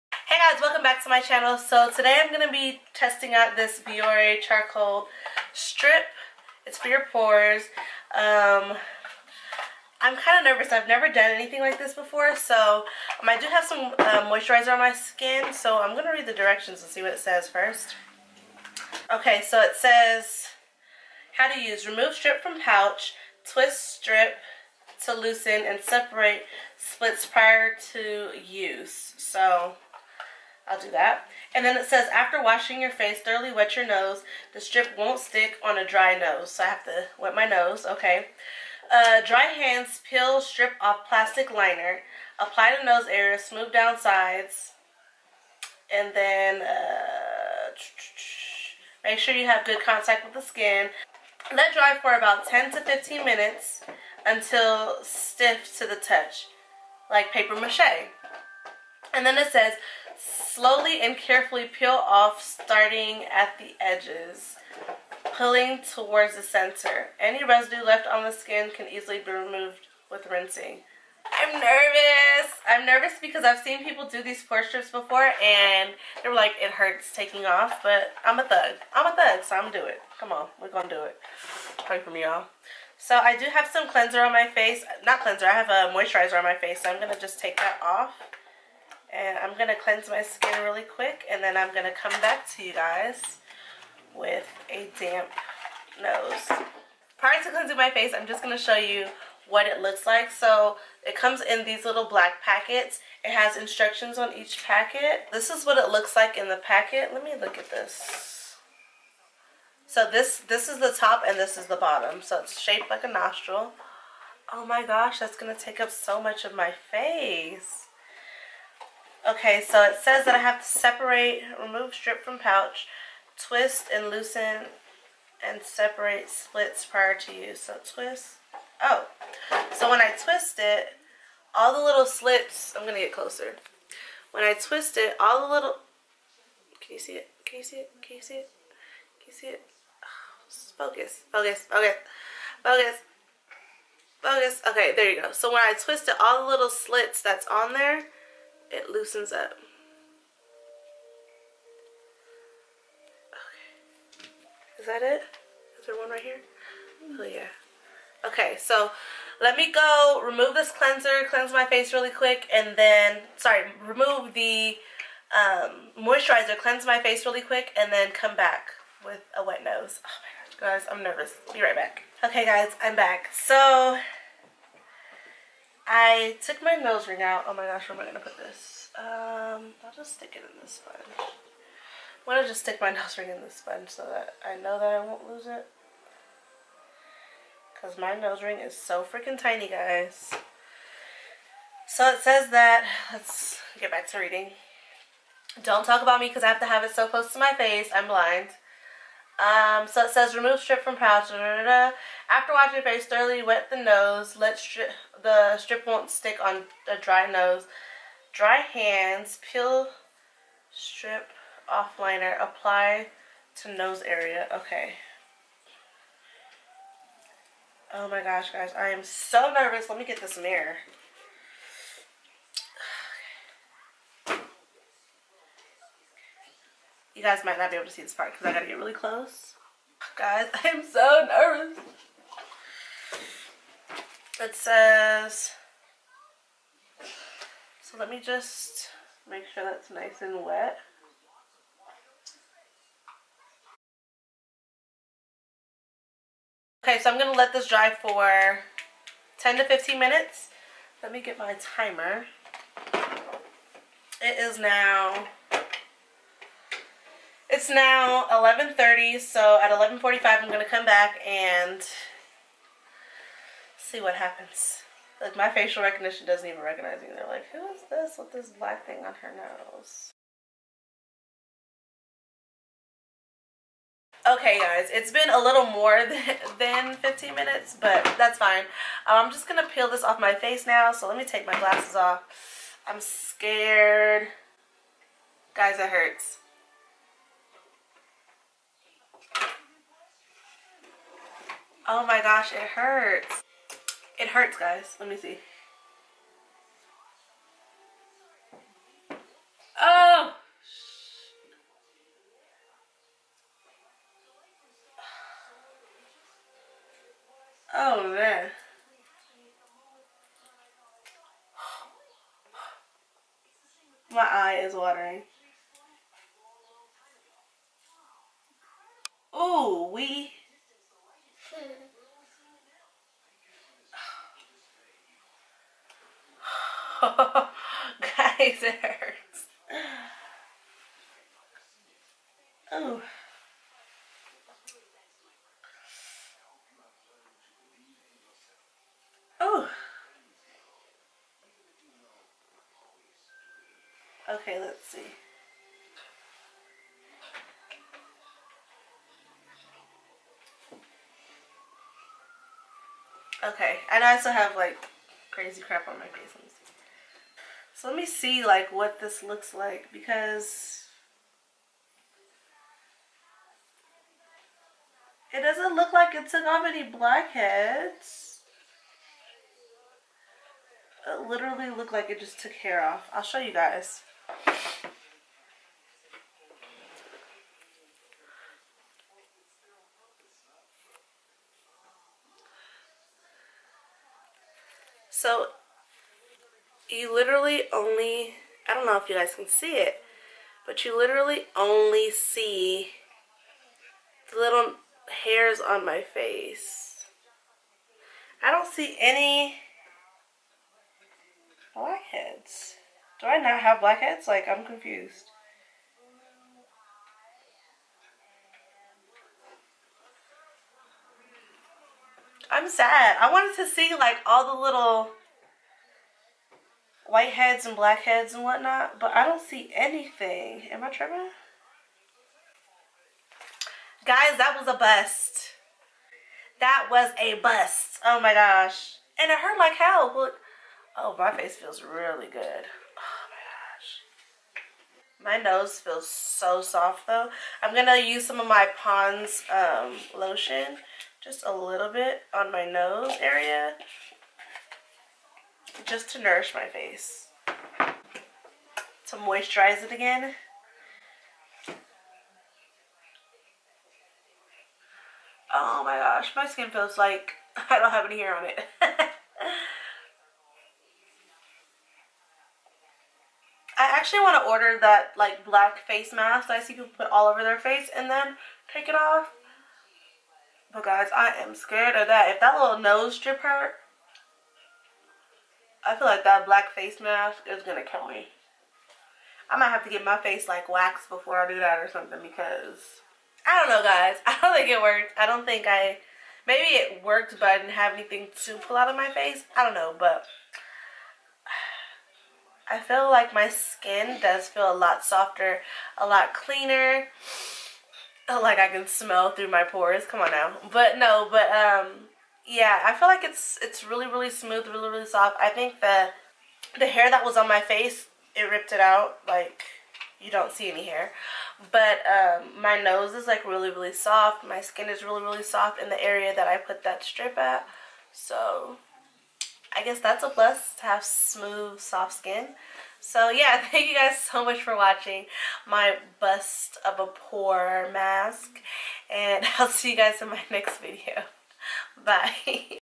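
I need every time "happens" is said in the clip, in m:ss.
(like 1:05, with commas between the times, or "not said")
4:24.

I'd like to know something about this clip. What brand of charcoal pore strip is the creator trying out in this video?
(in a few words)
Biore.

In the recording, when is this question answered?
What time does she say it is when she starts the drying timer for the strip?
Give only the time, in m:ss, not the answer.
4:18.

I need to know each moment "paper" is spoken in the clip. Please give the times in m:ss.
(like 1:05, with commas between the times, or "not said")
0:57.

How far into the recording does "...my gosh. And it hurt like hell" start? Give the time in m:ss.
7:08.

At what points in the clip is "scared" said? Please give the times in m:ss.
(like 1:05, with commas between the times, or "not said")
4:42, 7:51.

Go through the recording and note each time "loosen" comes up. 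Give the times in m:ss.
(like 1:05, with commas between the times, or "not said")
0:25, 2:04, 2:28.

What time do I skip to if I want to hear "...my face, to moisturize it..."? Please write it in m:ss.
7:26.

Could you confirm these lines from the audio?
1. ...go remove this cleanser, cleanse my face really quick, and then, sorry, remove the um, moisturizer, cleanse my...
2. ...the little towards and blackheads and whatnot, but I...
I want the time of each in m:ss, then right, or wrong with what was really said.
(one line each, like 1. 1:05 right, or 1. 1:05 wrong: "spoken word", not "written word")
1. 2:39 right
2. 6:54 wrong: "whiteheads", not "towards".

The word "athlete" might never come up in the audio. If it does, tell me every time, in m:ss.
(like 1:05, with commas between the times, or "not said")
not said.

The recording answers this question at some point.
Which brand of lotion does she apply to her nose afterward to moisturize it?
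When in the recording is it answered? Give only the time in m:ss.
7:18.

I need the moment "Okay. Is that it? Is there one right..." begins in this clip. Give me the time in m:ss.
2:33.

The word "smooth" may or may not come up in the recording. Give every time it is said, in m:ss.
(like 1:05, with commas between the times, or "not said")
0:43, 8:24, 8:41.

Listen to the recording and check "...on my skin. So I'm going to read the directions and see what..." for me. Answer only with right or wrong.
right.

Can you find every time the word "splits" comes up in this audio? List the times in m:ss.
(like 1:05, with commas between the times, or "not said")
0:26, 2:06.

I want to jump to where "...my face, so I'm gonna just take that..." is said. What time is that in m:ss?
1:26.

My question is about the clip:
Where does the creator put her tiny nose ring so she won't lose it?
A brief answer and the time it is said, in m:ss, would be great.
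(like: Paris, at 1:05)
in the sponge, at 3:03.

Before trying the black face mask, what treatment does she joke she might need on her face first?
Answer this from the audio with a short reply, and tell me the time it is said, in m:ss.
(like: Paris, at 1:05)
waxed, at 8:00.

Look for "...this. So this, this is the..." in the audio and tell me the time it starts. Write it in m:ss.
1:47.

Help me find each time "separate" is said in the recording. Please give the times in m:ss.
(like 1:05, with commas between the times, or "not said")
0:25, 2:00, 2:05.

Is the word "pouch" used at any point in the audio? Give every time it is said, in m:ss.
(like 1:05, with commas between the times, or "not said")
0:22, 2:02, 3:20.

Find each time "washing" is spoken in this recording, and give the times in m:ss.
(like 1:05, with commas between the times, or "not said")
0:32, 3:22.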